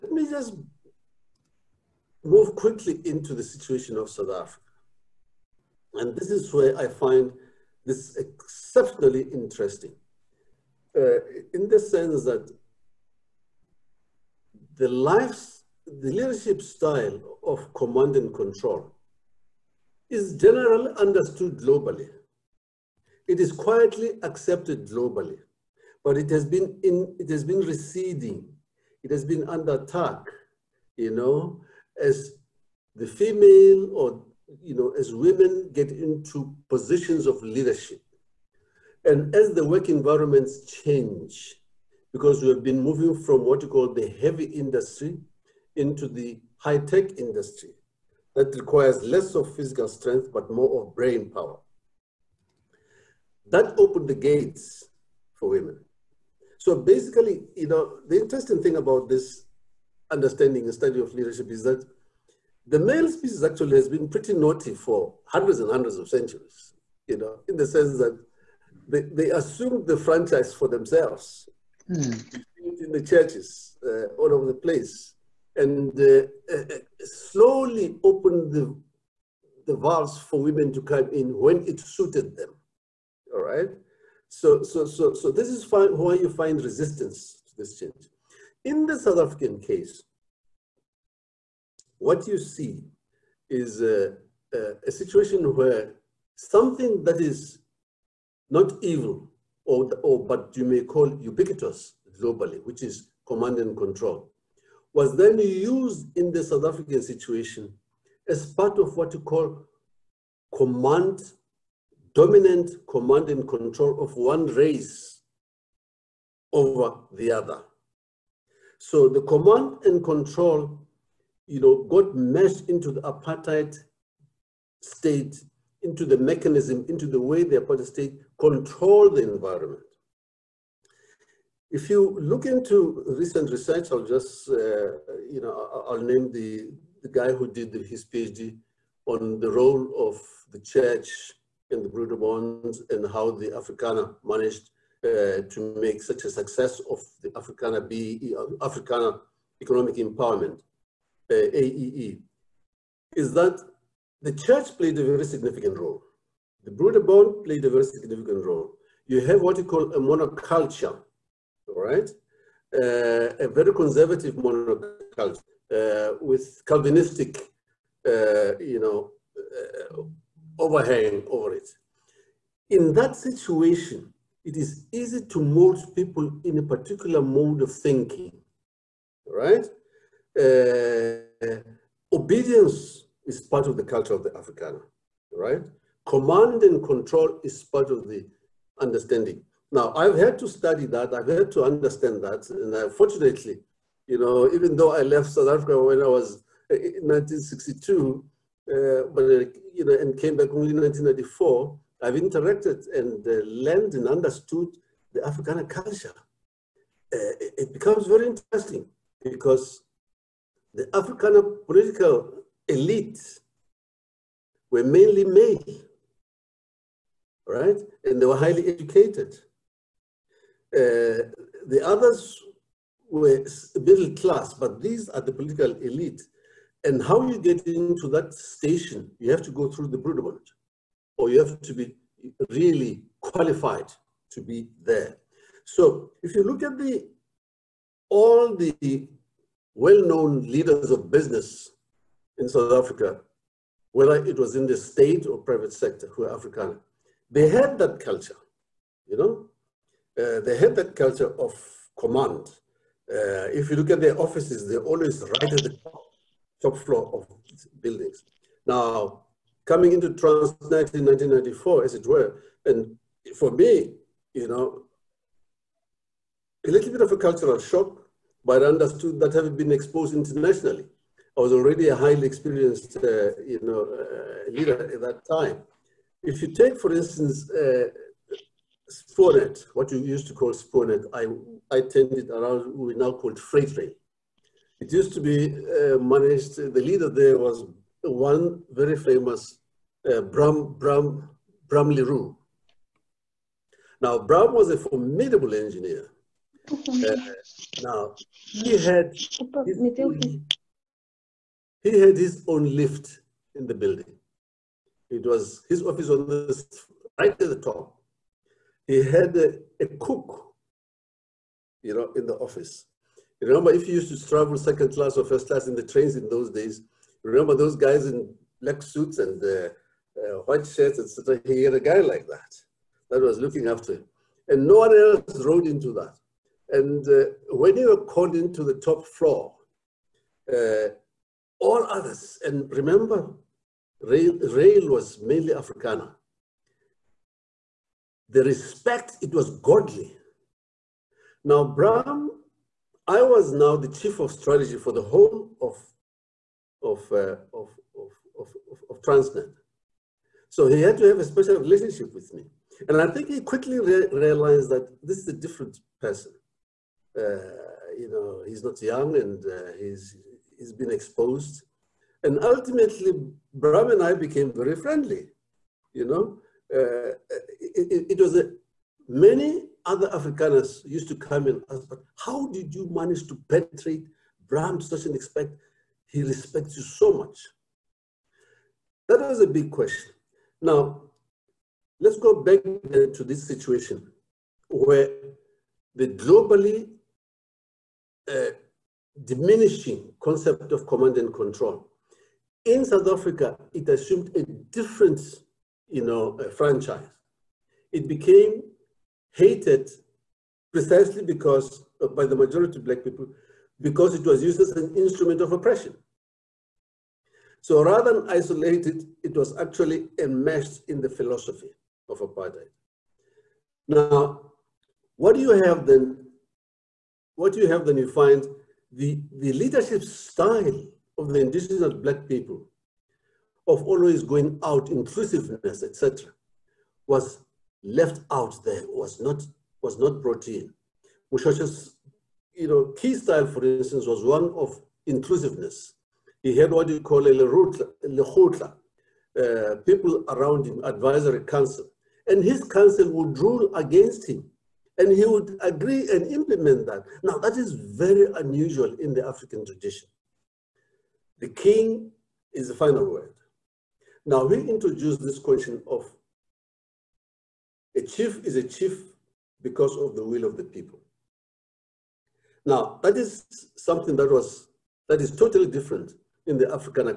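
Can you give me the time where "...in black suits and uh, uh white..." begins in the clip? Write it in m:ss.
5:18.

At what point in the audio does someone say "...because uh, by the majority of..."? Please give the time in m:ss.
6:41.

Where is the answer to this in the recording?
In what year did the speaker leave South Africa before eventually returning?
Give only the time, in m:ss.
3:17.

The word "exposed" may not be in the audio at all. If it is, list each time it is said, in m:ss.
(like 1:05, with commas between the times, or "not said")
4:29, 6:00.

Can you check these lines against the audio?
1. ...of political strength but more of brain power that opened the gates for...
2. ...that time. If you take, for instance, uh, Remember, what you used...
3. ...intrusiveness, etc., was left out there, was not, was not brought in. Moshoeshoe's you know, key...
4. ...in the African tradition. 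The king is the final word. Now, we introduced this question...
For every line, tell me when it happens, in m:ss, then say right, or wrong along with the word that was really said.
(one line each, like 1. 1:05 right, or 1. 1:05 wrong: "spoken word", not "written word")
1. 0:49 wrong: "physical", not "political"
2. 4:35 wrong: "Spoornet", not "Remember"
3. 7:04 right
4. 7:28 right.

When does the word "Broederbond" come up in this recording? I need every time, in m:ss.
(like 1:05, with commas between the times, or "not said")
2:21, 2:36, 3:49.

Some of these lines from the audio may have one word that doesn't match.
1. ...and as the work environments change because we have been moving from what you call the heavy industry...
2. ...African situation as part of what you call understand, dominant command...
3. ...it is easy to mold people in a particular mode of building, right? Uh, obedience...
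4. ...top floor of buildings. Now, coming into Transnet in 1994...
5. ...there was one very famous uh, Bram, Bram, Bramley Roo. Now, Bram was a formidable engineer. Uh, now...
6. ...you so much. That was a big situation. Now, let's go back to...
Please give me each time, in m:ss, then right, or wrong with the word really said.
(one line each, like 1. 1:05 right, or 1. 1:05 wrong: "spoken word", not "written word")
1. 0:39 right
2. 1:46 wrong: "command", not "understand"
3. 2:54 wrong: "thinking", not "building"
4. 4:16 right
5. 4:47 right
6. 6:16 wrong: "question", not "situation".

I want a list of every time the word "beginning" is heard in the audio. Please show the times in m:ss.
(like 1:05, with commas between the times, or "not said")
not said.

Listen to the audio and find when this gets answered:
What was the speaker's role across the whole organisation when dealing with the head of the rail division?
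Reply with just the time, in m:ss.
5:43.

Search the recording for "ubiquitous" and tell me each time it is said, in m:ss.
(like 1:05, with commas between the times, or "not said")
1:41.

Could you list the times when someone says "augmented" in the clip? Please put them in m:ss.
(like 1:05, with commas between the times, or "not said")
not said.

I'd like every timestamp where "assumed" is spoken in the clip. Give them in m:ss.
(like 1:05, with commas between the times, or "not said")
1:09, 6:33.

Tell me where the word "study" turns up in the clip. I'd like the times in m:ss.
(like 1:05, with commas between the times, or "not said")
1:00, 3:10.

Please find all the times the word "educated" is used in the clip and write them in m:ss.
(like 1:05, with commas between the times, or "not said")
3:38.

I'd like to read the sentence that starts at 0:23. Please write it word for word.
It is quietly accepted globally, but it has been in, it has been receding.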